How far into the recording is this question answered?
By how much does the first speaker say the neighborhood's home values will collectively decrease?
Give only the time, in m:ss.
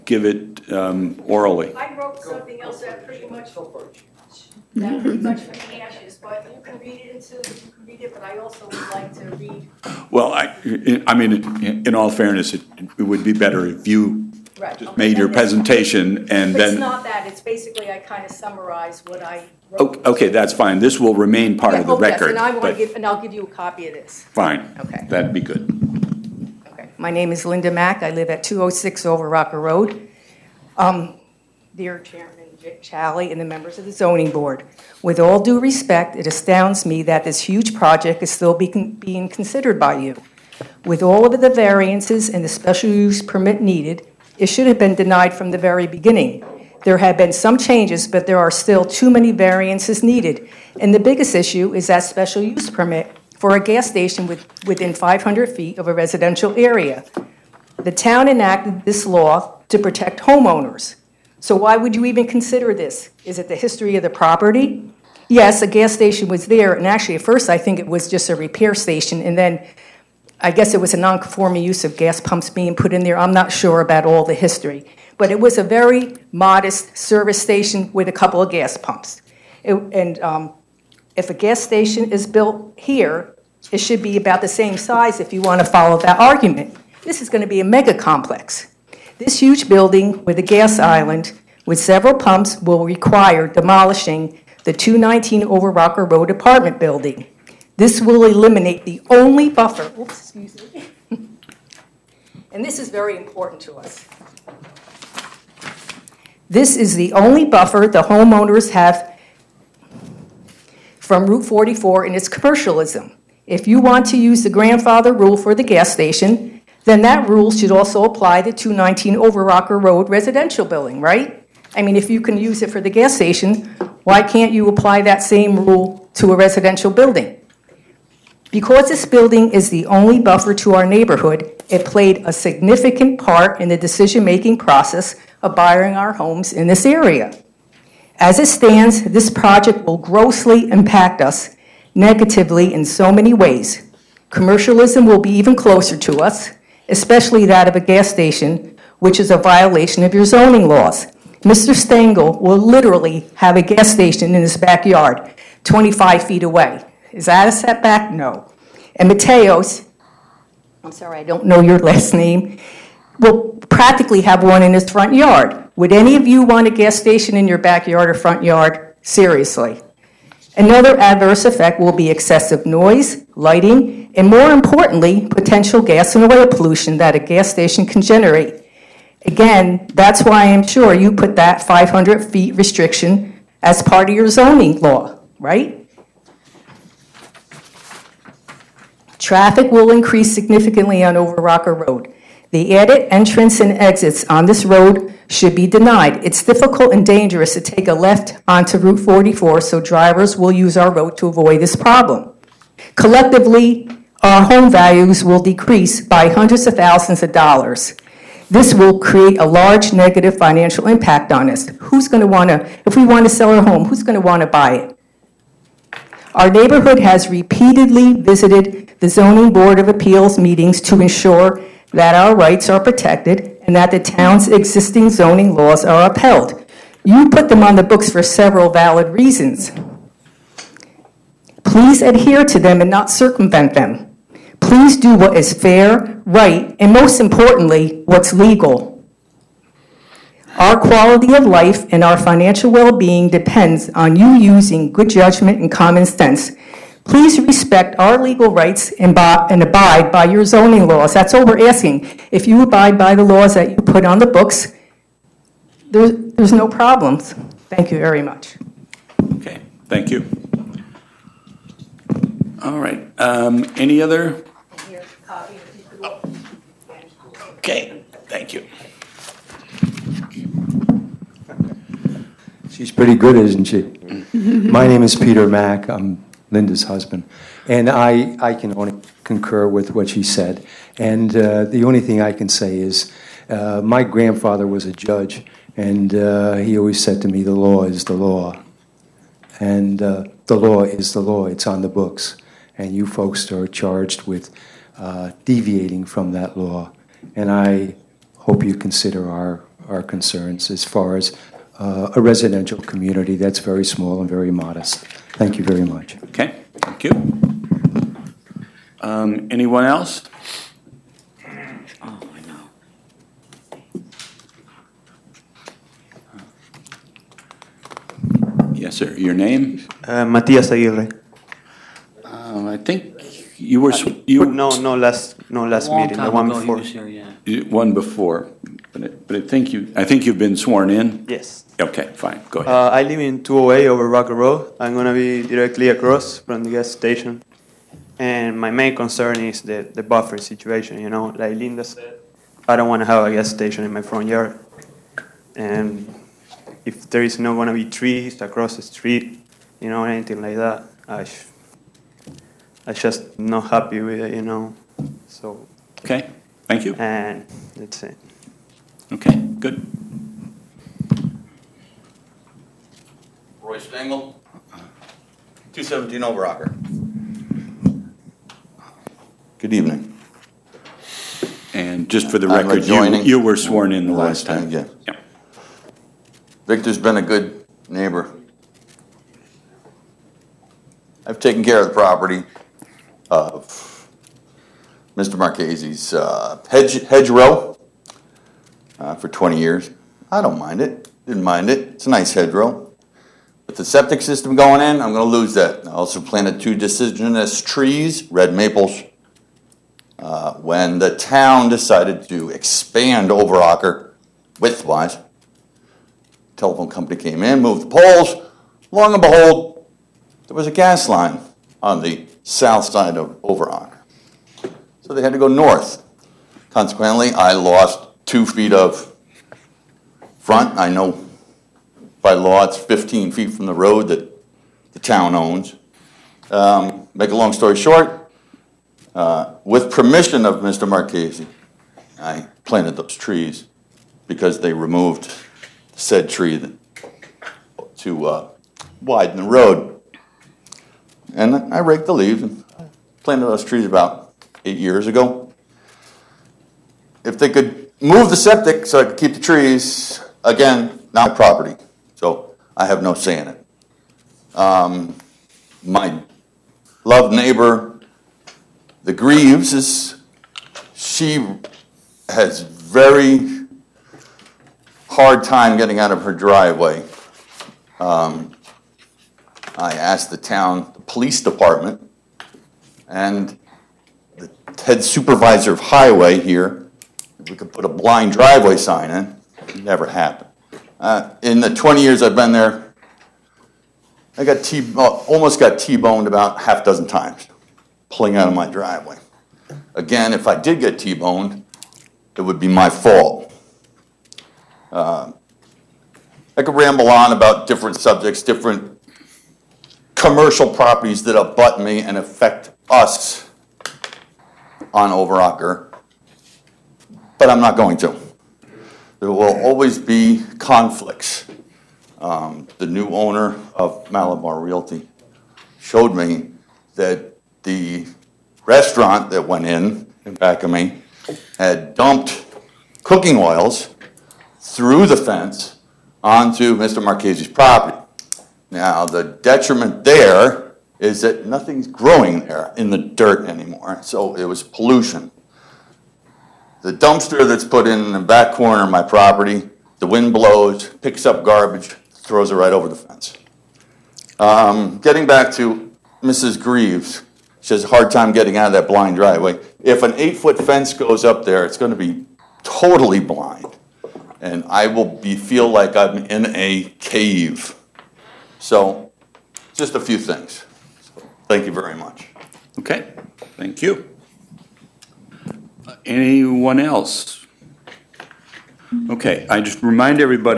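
3:26.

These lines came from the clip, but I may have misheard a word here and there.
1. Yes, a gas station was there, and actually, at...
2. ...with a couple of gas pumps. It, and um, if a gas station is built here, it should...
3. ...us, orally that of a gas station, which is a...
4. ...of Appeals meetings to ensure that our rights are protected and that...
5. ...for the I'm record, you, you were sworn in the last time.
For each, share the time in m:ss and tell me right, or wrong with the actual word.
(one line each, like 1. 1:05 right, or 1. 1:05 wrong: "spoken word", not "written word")
1. 1:05 right
2. 1:17 right
3. 2:26 wrong: "especially", not "orally"
4. 3:39 right
5. 6:12 right.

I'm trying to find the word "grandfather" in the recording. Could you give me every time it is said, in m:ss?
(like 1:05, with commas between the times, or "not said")
1:54, 4:44.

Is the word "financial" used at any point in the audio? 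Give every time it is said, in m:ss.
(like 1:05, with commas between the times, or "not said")
3:30, 4:02.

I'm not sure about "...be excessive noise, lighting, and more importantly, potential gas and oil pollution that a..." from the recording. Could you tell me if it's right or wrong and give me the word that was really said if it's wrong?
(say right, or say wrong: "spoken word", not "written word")
right.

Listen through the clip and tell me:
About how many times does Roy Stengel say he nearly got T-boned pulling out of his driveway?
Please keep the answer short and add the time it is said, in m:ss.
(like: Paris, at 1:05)
Half dozen, at 8:06.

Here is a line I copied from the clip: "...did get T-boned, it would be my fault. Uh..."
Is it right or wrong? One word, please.
right.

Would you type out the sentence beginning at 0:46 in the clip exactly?
There have been some changes, but there are still too many variances needed.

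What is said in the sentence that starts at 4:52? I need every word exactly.
And you folks are charged with uh, deviating from that law.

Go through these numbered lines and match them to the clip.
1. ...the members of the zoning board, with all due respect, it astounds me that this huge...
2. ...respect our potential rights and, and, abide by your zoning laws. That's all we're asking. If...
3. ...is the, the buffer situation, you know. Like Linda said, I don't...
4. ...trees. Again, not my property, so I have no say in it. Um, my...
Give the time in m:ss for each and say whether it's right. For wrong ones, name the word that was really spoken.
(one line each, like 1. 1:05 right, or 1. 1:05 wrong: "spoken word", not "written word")
1. 0:33 right
2. 4:07 wrong: "legal", not "potential"
3. 5:39 right
4. 7:29 right.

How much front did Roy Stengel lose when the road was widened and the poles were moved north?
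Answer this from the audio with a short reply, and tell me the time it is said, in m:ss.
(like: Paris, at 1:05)
2 feet, at 6:58.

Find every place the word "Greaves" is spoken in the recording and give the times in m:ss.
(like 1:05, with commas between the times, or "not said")
7:39, 9:06.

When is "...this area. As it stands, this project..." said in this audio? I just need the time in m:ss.
2:16.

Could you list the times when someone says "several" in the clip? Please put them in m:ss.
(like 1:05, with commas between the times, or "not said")
1:31, 3:48.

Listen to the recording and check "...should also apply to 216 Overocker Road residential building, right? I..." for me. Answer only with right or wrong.
wrong.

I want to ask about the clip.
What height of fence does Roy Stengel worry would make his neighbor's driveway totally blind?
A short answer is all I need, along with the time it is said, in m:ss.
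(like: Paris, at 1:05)
8 feet, at 9:10.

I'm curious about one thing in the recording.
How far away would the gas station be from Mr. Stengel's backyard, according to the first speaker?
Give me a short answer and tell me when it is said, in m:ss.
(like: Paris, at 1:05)
25 feet, at 2:35.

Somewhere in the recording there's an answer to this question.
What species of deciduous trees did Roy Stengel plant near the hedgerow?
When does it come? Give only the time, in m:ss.
6:38.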